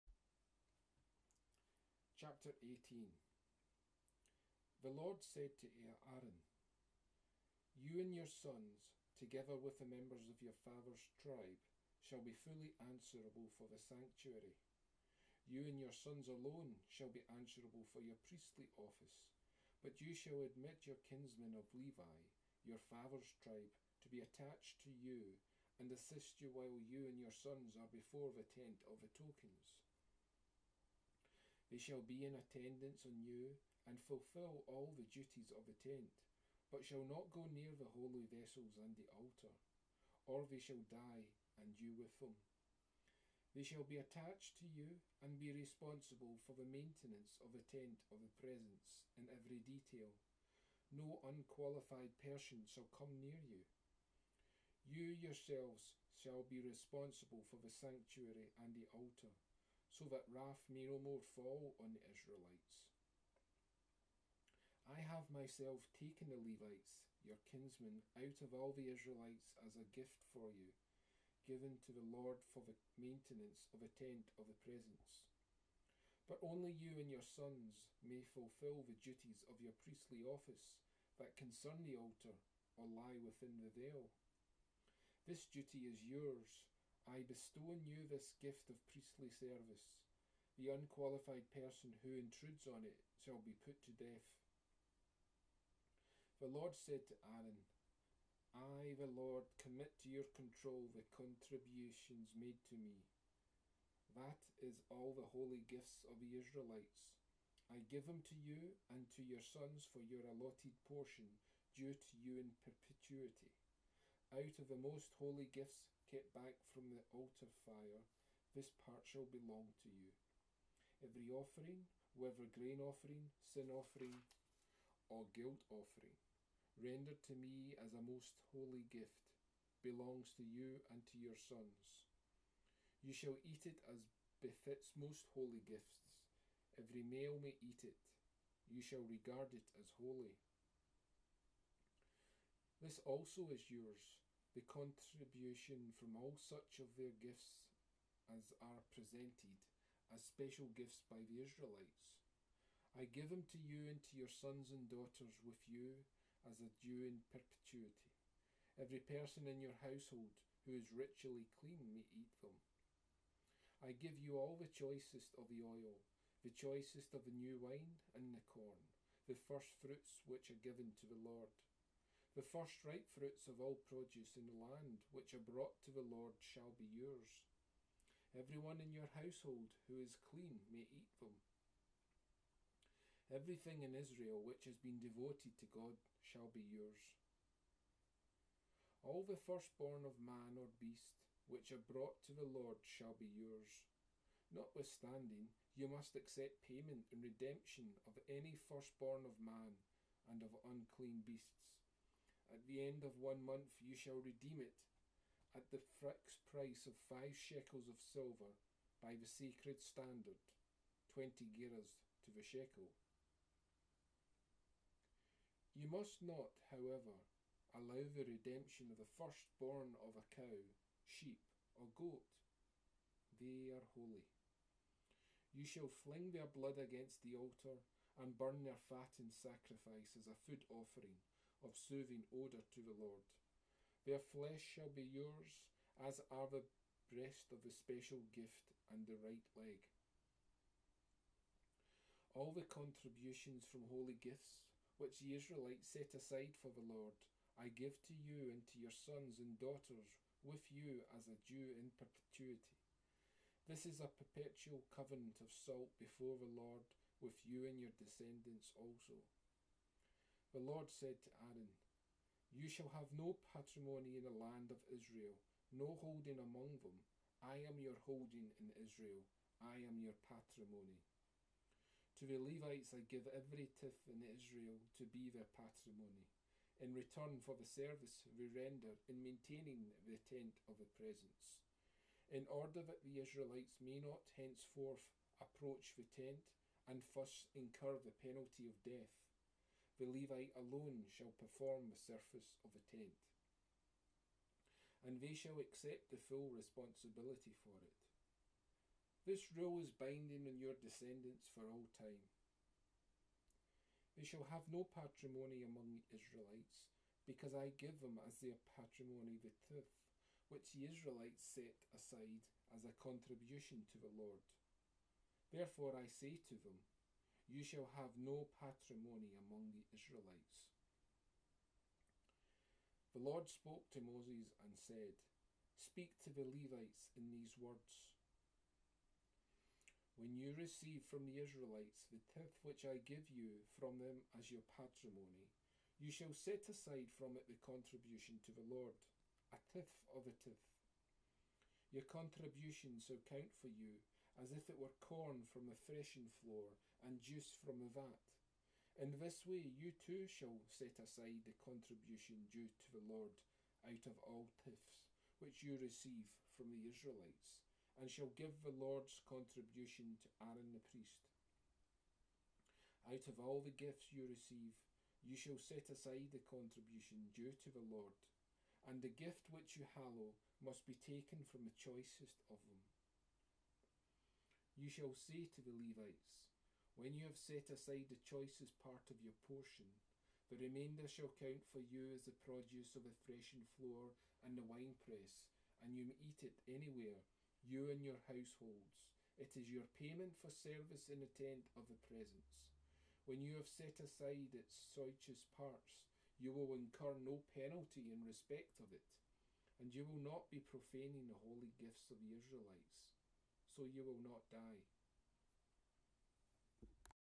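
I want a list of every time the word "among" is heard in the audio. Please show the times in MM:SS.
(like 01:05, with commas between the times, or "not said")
04:26, 05:05, 05:19.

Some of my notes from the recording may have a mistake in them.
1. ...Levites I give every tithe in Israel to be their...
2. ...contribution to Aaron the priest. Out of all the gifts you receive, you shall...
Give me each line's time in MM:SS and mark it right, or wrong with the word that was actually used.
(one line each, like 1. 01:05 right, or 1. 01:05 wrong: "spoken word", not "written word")
1. 04:32 right
2. 05:59 right.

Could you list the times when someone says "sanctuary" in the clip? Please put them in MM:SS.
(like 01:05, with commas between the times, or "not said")
00:13, 00:57.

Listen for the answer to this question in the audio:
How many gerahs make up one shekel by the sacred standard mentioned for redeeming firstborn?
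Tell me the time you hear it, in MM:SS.
03:31.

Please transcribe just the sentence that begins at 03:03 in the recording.
Everything in Israel which has been devoted to God shall be yours.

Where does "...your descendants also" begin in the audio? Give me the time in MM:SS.
04:17.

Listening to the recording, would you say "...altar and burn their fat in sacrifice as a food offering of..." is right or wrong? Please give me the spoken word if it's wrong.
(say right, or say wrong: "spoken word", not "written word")
right.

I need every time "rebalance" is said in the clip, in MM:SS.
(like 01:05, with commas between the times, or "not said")
not said.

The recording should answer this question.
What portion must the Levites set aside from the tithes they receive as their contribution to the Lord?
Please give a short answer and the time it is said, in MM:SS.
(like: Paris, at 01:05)
A tithe of a tithe, at 05:39.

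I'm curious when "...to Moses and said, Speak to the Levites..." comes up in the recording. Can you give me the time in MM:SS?
05:23.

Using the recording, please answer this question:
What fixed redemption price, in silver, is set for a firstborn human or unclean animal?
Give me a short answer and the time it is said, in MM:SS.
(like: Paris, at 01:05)
5 shekels, at 03:27.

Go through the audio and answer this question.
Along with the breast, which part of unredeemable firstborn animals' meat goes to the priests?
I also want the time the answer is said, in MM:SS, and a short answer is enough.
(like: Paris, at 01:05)
The right leg, at 03:59.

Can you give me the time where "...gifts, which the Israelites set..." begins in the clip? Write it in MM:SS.
04:04.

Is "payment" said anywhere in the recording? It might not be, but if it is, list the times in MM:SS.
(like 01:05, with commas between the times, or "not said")
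03:16, 06:30.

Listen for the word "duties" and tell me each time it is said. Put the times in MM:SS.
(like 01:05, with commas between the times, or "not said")
00:35, 01:19.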